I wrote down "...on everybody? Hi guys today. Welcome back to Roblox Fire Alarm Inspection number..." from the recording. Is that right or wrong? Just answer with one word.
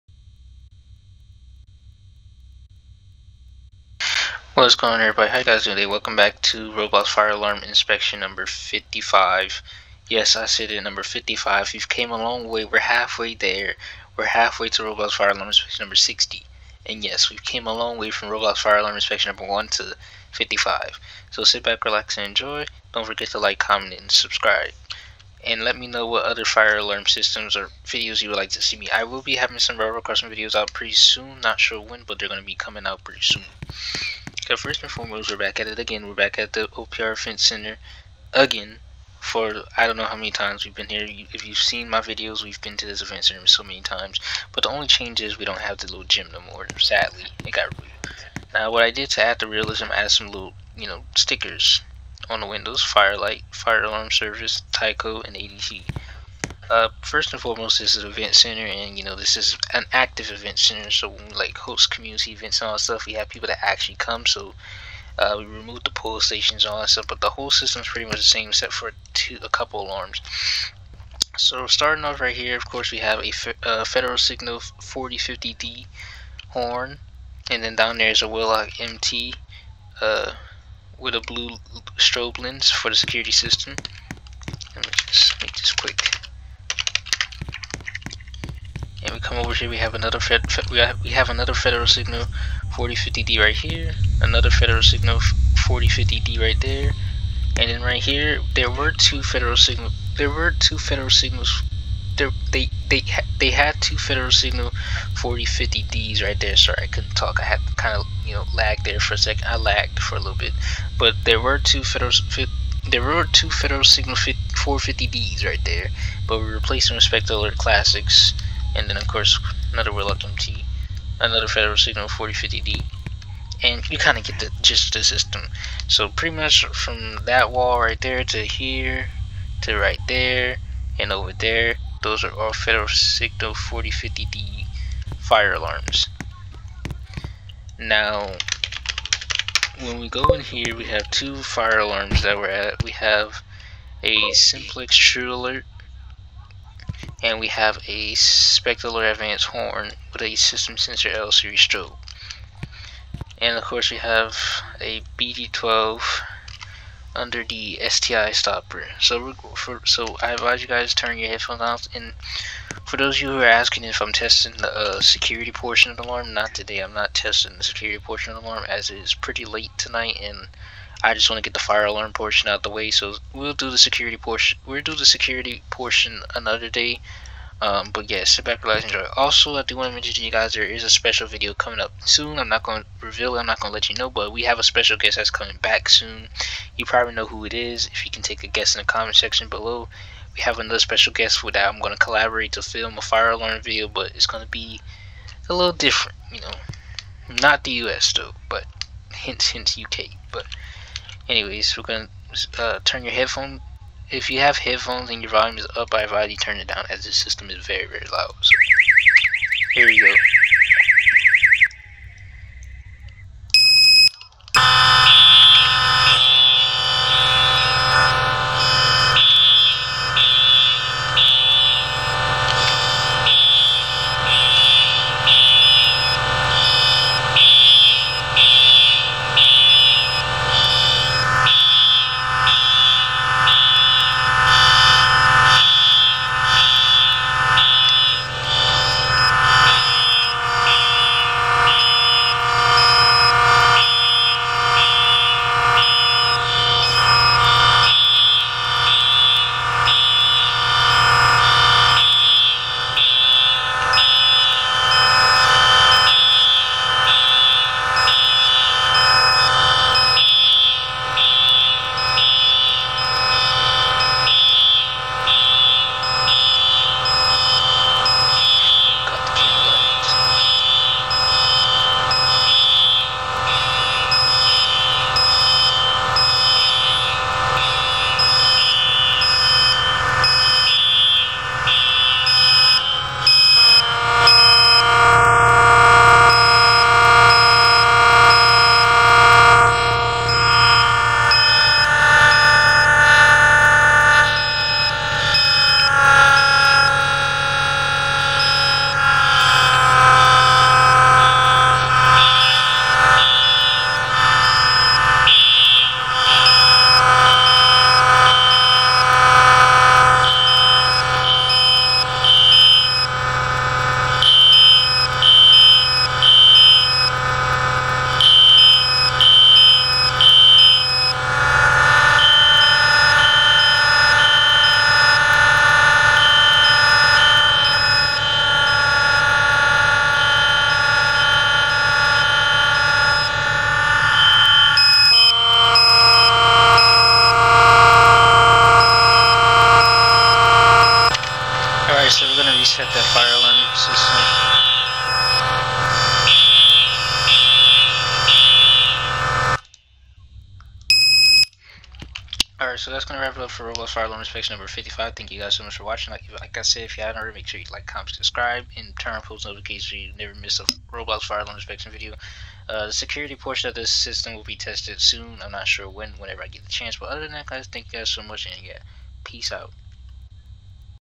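right.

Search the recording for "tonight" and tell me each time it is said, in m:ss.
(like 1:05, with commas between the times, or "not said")
2:49.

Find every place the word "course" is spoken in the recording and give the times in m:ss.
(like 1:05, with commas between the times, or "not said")
1:12, 1:59, 2:33.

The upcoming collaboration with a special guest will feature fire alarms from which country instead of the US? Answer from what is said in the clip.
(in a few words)
U.K.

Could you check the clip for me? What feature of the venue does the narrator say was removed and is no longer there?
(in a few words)
the little gym.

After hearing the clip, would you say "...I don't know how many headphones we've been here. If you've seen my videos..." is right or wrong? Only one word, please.
wrong.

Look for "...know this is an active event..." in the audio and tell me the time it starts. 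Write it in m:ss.
0:59.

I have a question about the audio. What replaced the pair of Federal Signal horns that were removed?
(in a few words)
Alert Classics.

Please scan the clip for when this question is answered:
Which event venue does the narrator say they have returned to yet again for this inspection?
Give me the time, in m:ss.
0:36.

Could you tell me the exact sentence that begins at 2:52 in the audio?
So we'll do the security portion.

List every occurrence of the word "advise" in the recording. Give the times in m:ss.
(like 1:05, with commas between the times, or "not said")
2:40, 3:26.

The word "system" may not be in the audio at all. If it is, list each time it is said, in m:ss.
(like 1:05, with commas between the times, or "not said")
0:27, 1:07, 1:23, 2:05, 2:30, 3:27, 6:03.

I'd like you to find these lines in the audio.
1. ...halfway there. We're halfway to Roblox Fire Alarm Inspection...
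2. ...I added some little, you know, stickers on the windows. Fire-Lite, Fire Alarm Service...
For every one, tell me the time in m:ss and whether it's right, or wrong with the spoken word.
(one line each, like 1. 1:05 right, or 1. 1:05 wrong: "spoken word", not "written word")
1. 0:12 right
2. 0:49 right.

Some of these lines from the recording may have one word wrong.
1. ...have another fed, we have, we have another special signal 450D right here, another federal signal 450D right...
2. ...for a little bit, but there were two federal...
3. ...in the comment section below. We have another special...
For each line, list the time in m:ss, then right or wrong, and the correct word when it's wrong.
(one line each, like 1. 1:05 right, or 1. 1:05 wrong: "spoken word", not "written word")
1. 1:29 wrong: "federal", not "special"
2. 1:49 right
3. 3:08 right.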